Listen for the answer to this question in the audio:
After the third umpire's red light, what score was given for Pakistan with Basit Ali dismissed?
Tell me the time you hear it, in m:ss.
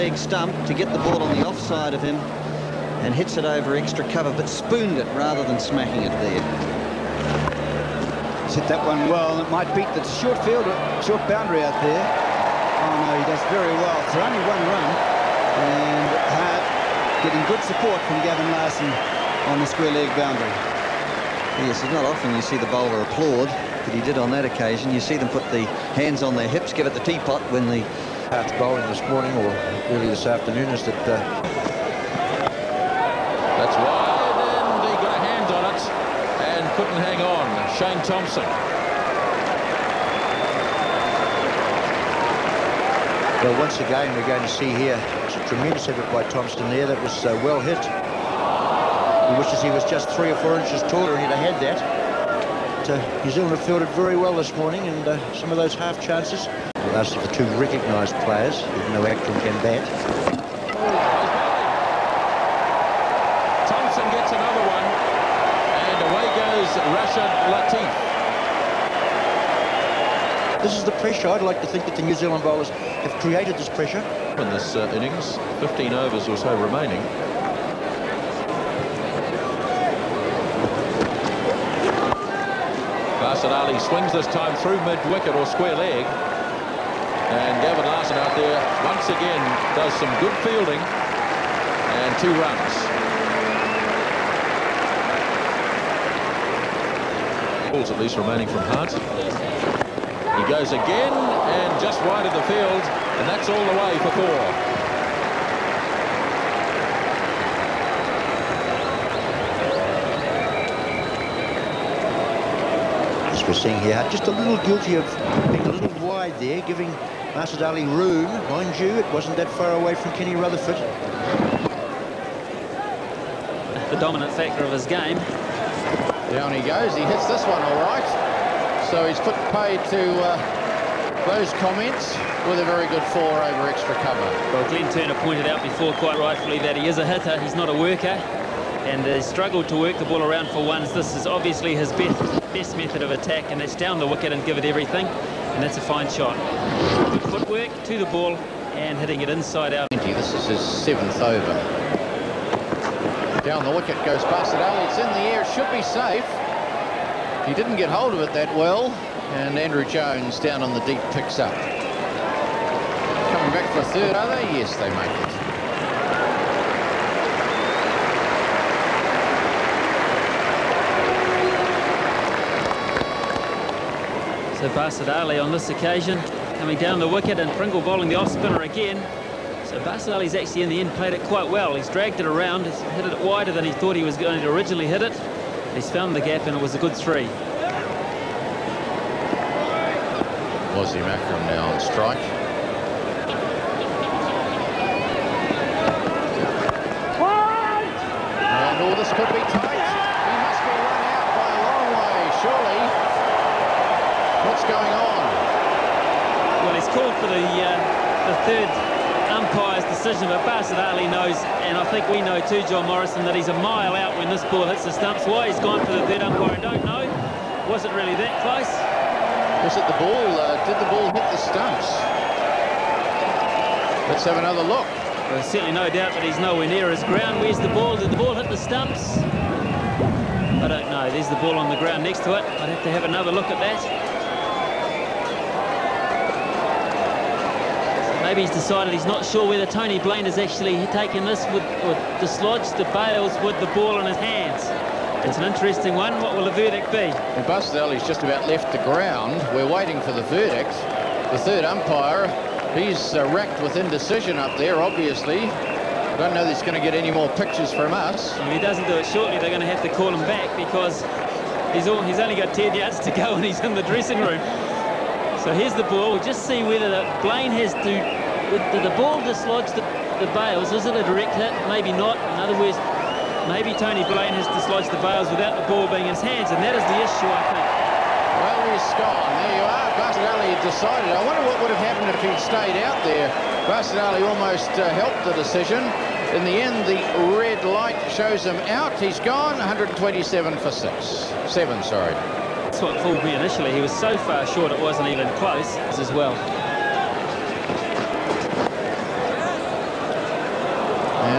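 4:49.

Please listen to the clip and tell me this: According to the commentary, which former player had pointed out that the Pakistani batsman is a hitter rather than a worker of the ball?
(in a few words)
Glenn Turner.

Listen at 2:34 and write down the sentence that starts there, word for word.
it's in the air, should be safe.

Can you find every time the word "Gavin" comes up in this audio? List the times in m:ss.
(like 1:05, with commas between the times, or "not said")
0:18, 1:27.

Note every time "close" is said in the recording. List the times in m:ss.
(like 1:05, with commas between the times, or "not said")
3:38, 4:55.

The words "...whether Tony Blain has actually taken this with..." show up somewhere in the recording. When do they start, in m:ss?
3:59.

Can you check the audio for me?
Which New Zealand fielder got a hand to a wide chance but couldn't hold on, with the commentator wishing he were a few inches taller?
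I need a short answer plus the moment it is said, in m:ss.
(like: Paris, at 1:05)
Shane Thomson, at 0:37.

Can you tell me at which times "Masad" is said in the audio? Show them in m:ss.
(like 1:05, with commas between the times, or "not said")
1:57.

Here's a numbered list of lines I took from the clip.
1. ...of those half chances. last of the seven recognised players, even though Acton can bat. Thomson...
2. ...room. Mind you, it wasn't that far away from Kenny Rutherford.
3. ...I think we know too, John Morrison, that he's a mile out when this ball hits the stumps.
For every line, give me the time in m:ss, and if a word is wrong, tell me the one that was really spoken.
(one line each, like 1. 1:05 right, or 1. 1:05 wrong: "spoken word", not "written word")
1. 0:55 wrong: "two", not "seven"
2. 1:57 right
3. 3:31 right.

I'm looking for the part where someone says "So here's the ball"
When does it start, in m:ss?
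4:25.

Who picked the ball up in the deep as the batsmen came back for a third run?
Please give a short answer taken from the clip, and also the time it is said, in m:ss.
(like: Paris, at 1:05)
Andrew Jones, at 2:39.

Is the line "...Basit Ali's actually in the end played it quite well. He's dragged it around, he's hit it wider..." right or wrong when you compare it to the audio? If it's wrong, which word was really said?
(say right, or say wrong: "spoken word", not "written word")
right.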